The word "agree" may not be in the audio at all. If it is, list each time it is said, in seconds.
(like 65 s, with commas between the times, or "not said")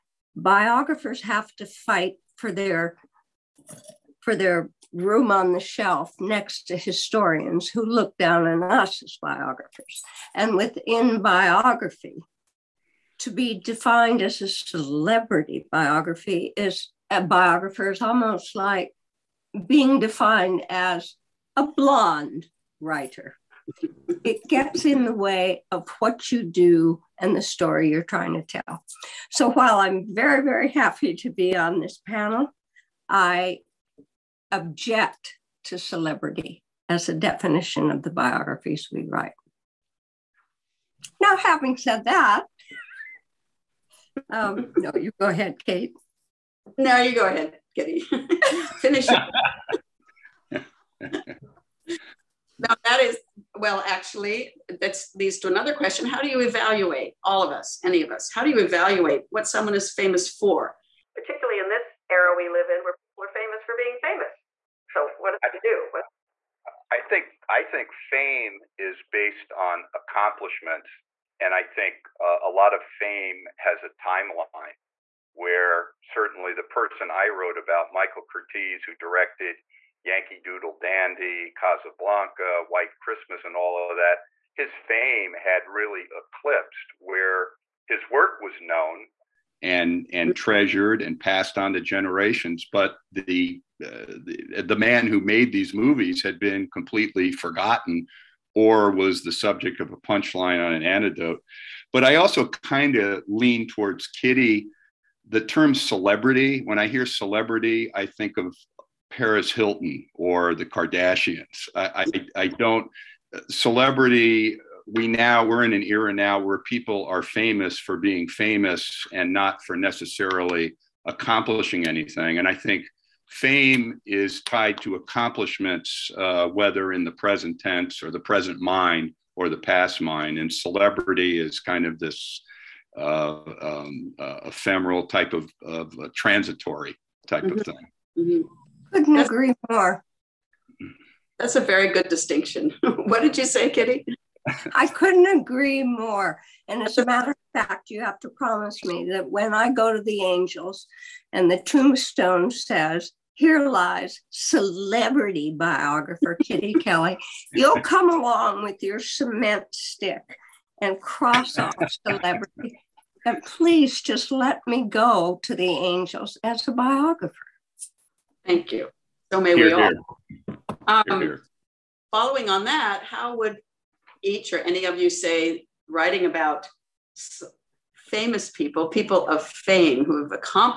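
139 s, 145 s.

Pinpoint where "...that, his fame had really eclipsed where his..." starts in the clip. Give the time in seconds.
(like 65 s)
83 s.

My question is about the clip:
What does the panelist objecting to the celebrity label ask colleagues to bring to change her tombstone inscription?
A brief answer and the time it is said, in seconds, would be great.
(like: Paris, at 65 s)
cement stick, at 158 s.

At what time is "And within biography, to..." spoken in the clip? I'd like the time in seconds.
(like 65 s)
10 s.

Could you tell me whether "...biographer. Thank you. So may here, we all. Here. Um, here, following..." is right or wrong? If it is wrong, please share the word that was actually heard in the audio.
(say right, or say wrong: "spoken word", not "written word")
right.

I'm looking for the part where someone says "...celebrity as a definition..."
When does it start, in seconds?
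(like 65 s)
35 s.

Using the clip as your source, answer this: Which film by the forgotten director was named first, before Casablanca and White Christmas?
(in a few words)
Yankee Doodle Dandy.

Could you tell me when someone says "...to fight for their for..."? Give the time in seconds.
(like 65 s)
1 s.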